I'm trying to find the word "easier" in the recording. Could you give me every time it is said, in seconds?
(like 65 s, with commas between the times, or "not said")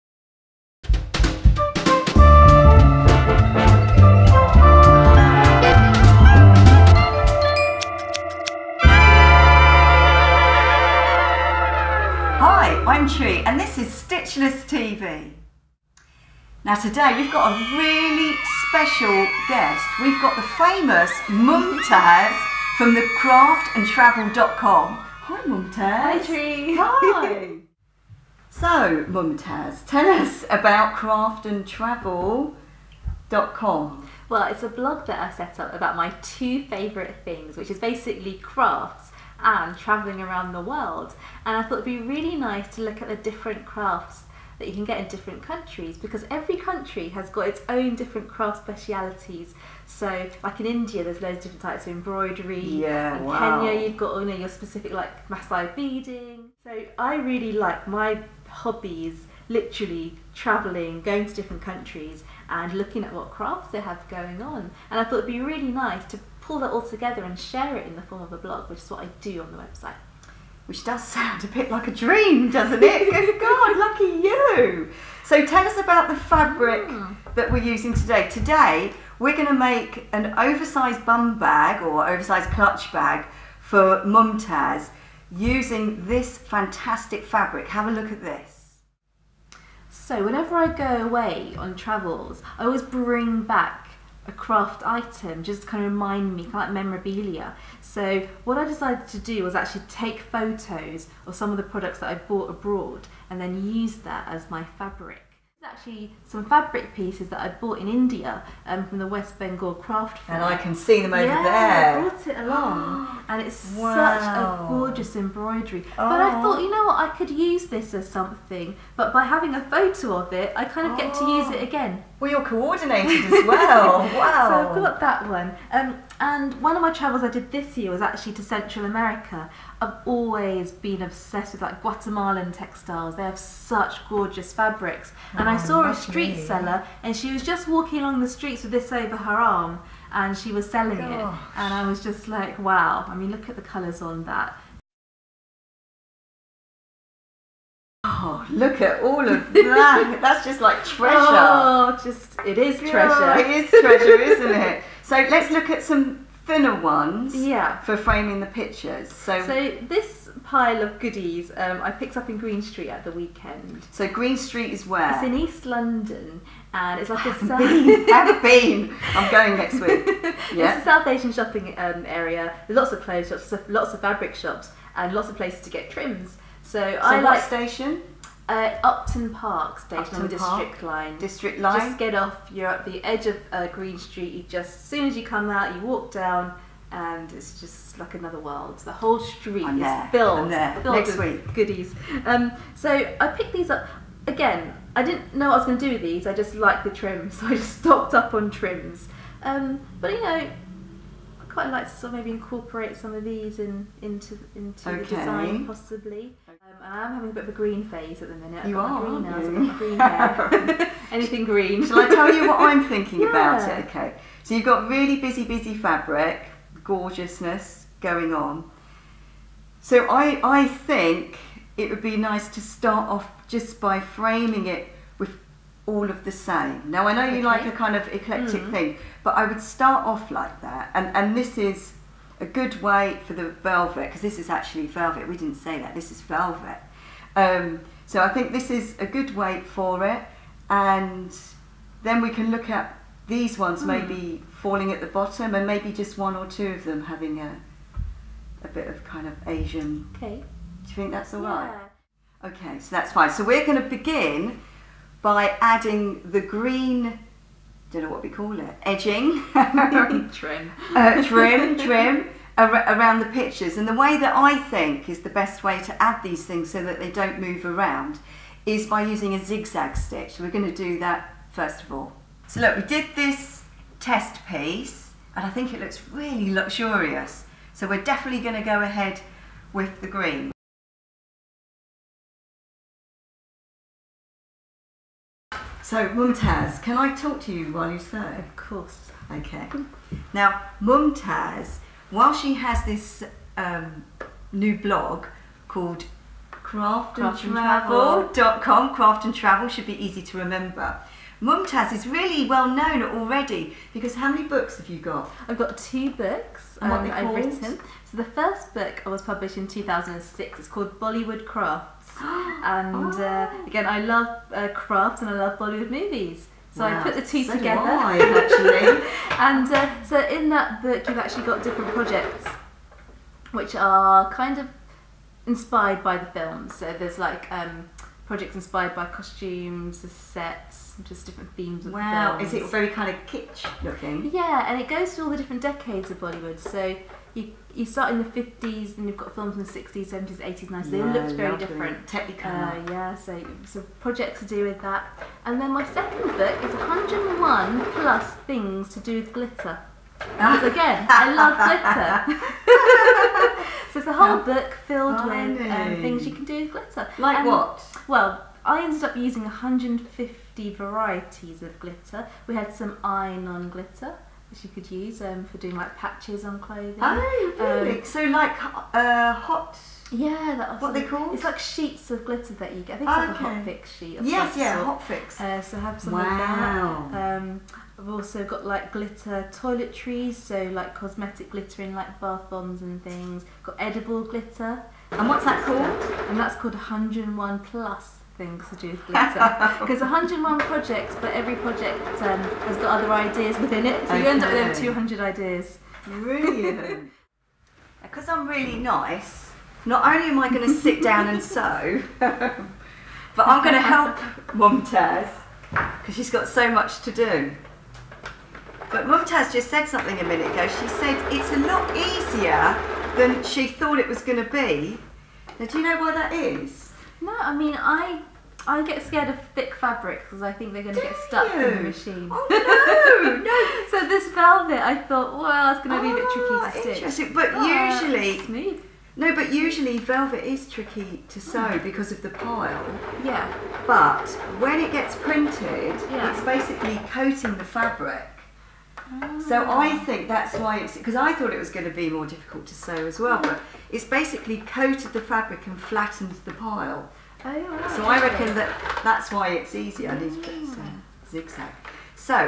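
411 s, 449 s.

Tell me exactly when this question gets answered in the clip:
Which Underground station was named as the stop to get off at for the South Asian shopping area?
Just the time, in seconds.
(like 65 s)
178 s.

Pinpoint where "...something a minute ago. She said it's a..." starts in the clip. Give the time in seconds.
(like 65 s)
409 s.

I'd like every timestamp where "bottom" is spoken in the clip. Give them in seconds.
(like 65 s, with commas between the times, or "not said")
245 s.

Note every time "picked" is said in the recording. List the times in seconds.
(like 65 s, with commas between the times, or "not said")
161 s, 193 s.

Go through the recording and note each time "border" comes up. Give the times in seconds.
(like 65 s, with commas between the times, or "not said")
not said.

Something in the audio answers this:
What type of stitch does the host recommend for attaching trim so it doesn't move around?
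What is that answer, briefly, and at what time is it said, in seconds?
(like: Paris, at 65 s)
zigzag stitch, at 269 s.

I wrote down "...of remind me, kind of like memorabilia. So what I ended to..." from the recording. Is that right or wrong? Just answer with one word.
wrong.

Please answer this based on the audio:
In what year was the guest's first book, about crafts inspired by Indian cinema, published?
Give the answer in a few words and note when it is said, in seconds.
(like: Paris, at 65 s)
2006, at 309 s.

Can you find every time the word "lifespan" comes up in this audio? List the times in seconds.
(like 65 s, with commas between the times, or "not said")
not said.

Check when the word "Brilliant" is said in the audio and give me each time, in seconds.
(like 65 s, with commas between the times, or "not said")
396 s.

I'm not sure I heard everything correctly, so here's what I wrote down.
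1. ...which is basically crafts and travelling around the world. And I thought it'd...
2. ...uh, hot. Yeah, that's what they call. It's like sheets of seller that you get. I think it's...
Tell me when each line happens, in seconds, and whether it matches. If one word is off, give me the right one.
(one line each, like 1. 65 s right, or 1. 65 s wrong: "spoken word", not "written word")
1. 37 s right
2. 368 s wrong: "glitter", not "seller".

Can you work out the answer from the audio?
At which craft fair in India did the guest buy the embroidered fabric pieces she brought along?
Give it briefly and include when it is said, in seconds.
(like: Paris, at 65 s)
West Bengal craft fair, at 109 s.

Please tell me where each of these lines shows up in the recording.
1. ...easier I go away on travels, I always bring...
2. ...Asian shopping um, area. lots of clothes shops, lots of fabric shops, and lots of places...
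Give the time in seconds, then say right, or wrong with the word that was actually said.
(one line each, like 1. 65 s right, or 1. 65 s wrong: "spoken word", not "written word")
1. 90 s wrong: "whenever", not "easier"
2. 171 s right.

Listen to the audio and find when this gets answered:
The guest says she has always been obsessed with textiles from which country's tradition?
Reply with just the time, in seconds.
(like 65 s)
131 s.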